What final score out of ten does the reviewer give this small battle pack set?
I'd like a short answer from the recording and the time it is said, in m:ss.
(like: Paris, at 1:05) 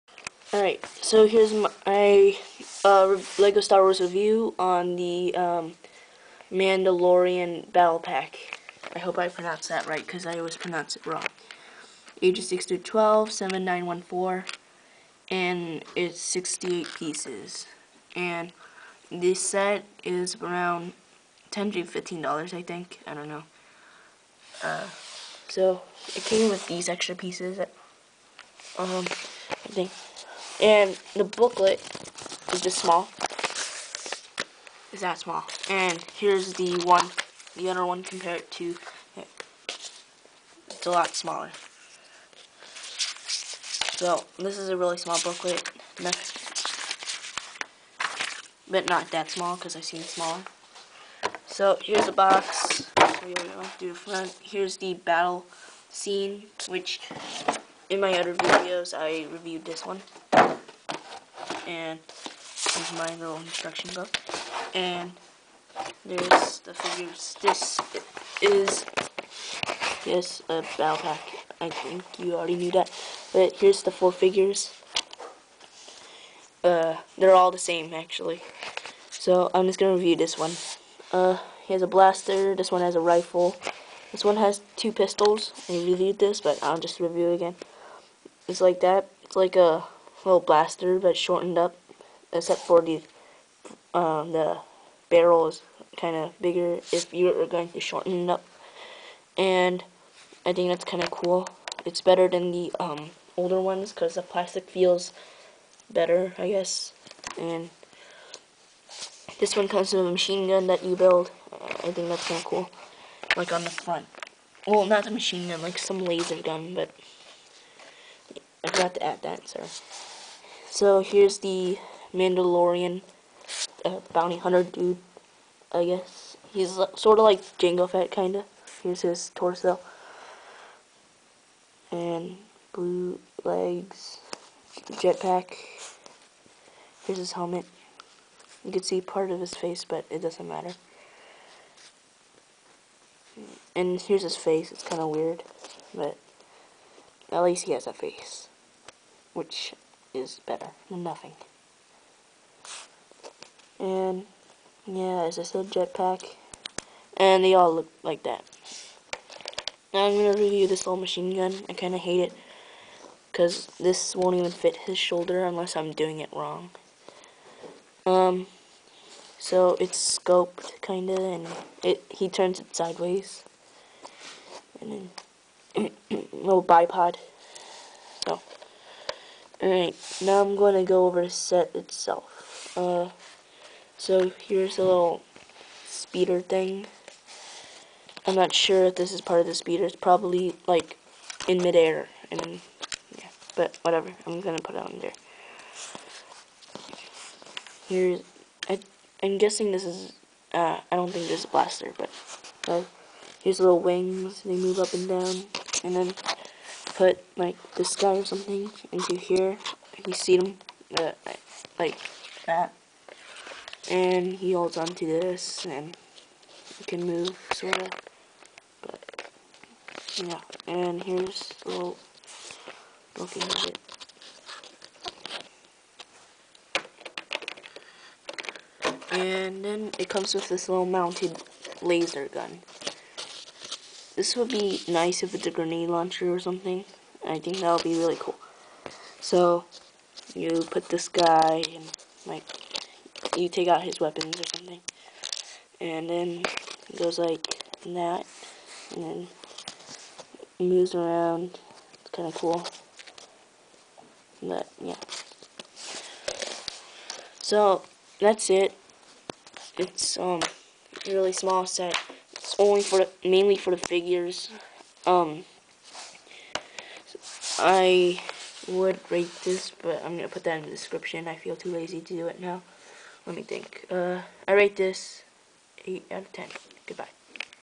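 8 out of 10, at 4:35.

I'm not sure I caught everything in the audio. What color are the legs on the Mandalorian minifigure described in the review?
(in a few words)
Blue.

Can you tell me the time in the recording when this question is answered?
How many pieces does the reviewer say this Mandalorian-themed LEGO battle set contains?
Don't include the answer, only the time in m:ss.
0:16.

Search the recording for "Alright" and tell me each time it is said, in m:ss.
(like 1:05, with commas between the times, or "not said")
0:00, 2:59.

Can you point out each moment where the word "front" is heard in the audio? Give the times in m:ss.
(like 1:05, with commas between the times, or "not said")
0:53, 1:53.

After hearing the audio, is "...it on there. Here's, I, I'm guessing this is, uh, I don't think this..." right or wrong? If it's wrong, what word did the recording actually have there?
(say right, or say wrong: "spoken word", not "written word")
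right.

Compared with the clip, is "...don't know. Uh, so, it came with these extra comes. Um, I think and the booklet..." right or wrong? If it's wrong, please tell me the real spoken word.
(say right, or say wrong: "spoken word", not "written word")
wrong: "pieces", not "comes".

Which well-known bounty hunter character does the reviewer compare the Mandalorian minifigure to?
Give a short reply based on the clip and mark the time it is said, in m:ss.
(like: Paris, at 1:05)
Jango Fett, at 2:07.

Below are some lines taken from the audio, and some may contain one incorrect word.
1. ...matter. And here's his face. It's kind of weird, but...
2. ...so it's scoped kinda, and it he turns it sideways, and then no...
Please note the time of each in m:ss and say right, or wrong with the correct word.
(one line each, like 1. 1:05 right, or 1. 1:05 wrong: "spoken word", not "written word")
1. 2:20 right
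2. 2:49 right.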